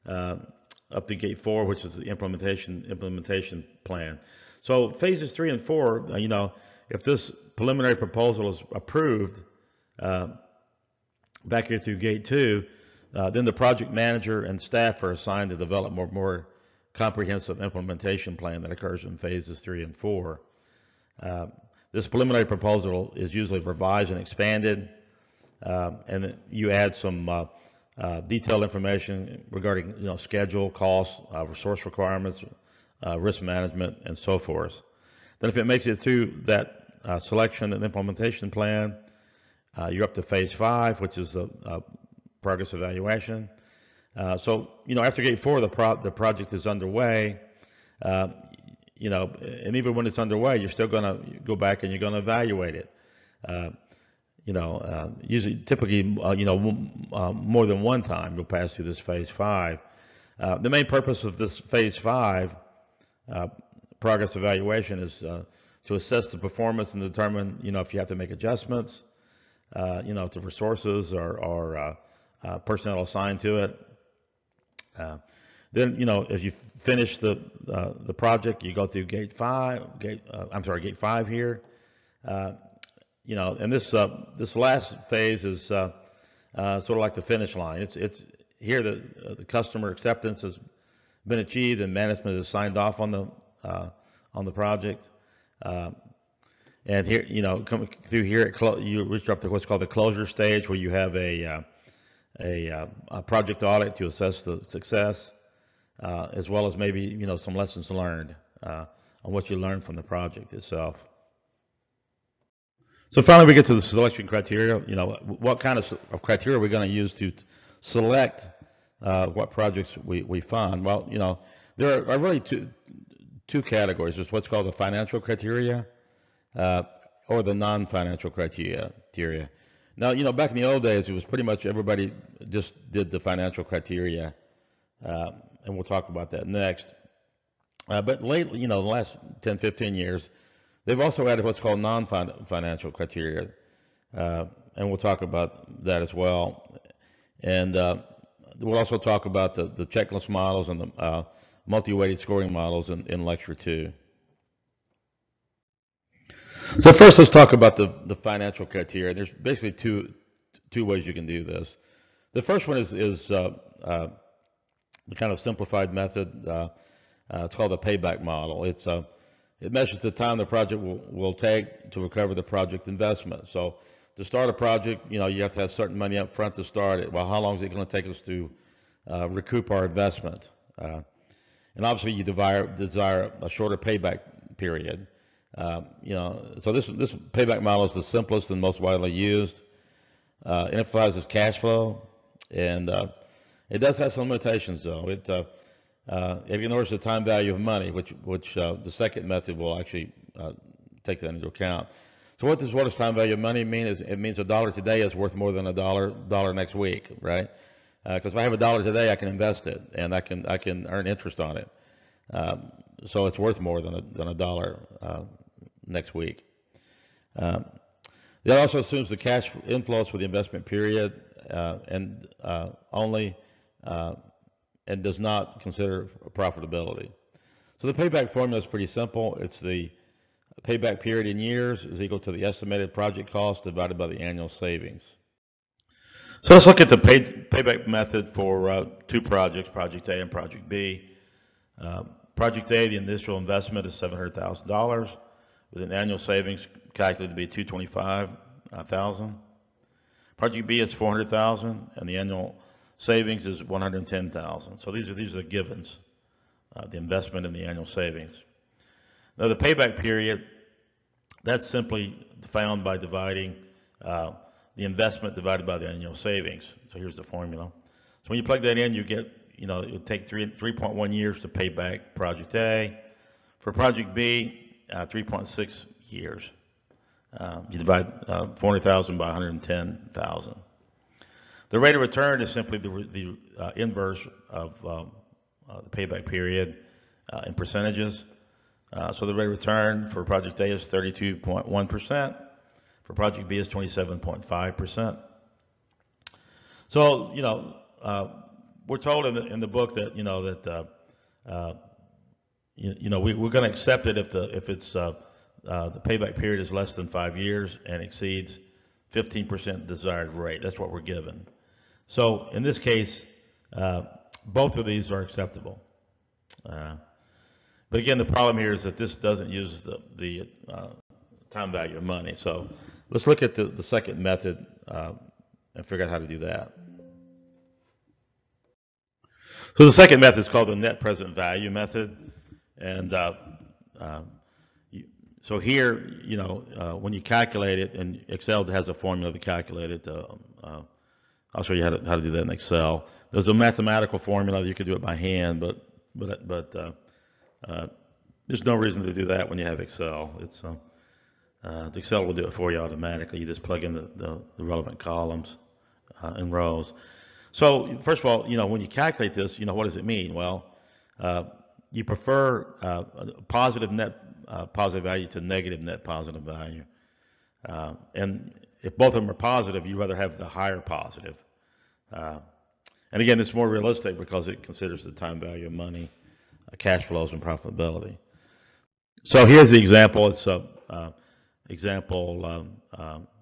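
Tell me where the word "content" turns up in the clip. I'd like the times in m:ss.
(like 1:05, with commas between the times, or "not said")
not said.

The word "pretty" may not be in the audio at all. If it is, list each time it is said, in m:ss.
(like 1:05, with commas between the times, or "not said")
2:11, 3:48.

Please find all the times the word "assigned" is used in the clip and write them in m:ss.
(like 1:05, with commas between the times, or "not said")
0:15, 1:13.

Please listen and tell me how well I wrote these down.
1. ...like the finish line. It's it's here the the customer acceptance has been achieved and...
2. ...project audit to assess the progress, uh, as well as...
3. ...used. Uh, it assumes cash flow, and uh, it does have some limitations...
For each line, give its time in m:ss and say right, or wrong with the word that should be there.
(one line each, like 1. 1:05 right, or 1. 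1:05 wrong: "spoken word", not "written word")
1. 1:26 right
2. 1:43 wrong: "success", not "progress"
3. 3:09 wrong: "emphasizes", not "assumes".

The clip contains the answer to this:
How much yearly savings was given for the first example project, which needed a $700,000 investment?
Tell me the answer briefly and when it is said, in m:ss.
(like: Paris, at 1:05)
$225,000, at 4:07.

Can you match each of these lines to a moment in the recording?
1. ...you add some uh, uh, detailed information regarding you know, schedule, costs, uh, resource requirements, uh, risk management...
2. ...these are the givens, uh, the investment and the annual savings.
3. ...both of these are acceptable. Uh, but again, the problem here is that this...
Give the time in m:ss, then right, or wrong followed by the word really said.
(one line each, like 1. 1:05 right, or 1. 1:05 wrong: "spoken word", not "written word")
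1. 0:26 right
2. 4:15 right
3. 5:14 right.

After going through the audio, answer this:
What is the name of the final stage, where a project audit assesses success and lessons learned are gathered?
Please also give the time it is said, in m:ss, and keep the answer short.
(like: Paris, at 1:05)
Closure stage, at 1:39.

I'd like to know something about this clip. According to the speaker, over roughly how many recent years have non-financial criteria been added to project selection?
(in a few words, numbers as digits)
10 to 15 years.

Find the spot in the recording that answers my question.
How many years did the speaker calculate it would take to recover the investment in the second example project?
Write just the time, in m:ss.
4:35.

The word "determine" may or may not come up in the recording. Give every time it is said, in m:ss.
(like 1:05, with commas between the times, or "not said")
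1:07.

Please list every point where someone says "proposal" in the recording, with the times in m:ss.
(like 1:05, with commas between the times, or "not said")
0:07, 0:22.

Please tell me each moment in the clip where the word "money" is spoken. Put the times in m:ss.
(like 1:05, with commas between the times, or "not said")
2:55, 3:17, 3:23, 5:22, 6:15.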